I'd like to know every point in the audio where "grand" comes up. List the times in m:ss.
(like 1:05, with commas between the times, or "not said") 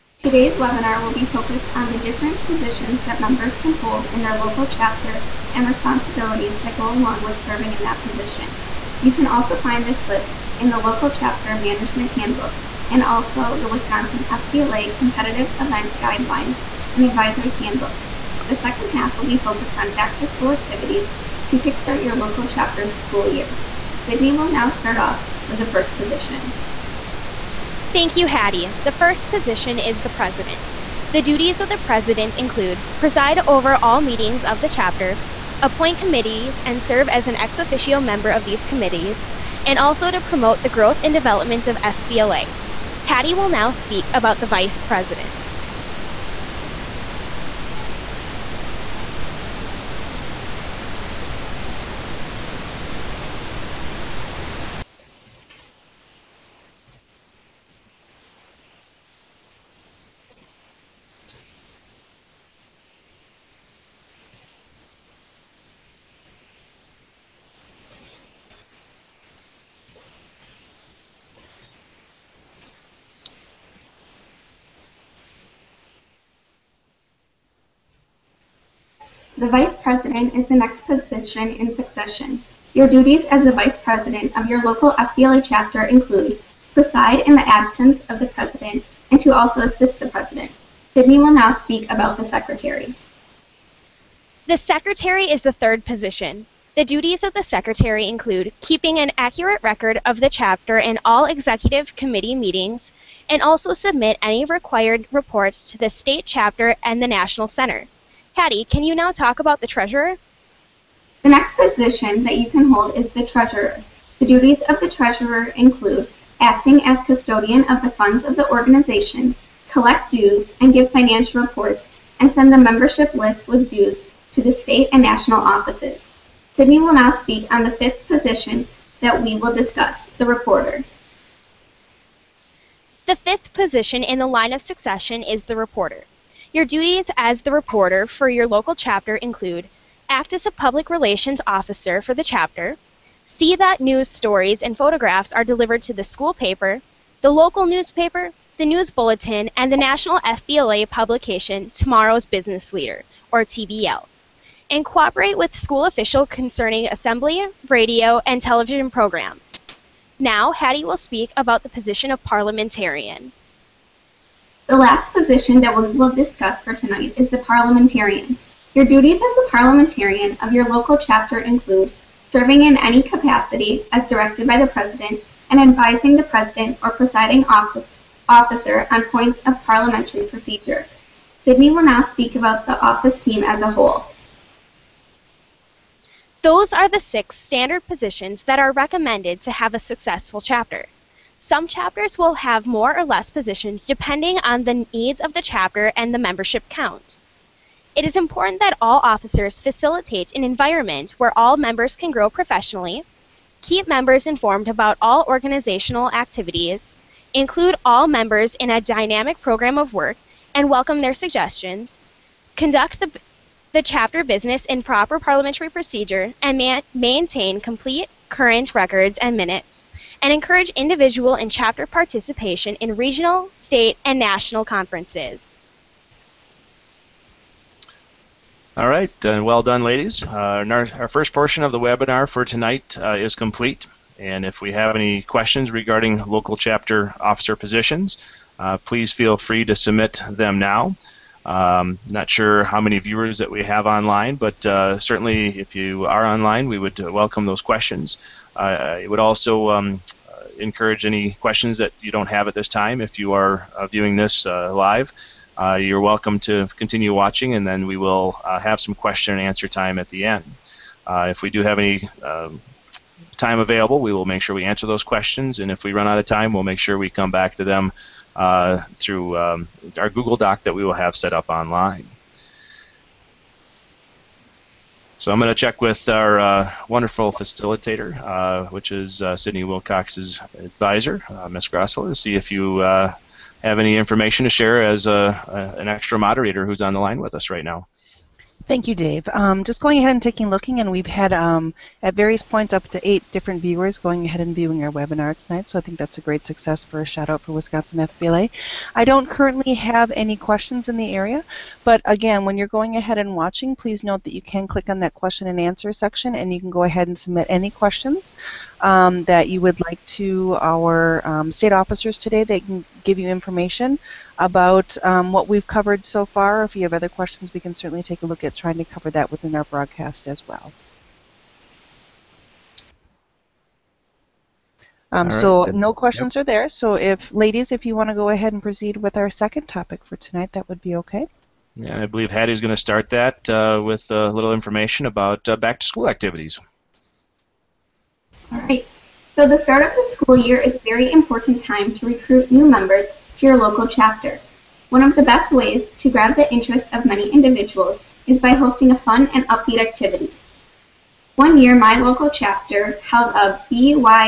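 not said.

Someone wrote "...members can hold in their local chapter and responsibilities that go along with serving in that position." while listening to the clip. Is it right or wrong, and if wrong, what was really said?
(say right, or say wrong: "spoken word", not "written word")
right.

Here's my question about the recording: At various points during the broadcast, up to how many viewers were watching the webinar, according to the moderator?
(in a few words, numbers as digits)
8.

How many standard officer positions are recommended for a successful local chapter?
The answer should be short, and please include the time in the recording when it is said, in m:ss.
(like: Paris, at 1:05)
6, at 3:06.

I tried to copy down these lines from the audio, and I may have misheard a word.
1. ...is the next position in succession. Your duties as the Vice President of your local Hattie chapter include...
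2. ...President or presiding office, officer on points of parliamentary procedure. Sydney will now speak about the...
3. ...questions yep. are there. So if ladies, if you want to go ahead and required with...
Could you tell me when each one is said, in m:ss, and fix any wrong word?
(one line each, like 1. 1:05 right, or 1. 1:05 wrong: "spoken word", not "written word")
1. 1:20 wrong: "FBLA", not "Hattie"
2. 2:56 right
3. 5:25 wrong: "proceed", not "required".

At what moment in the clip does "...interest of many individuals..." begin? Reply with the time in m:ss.
5:46.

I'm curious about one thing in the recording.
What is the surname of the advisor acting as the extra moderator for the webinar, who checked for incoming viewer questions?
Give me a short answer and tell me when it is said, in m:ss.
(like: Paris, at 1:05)
Grassel, at 4:41.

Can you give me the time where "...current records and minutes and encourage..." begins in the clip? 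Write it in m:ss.
3:38.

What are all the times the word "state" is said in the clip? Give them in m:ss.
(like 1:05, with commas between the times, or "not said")
1:45, 2:04, 3:43, 5:11.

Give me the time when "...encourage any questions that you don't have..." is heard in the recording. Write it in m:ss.
4:10.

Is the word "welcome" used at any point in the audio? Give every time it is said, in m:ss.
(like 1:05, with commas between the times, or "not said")
3:30, 4:07, 4:15.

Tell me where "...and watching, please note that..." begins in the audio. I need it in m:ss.
5:03.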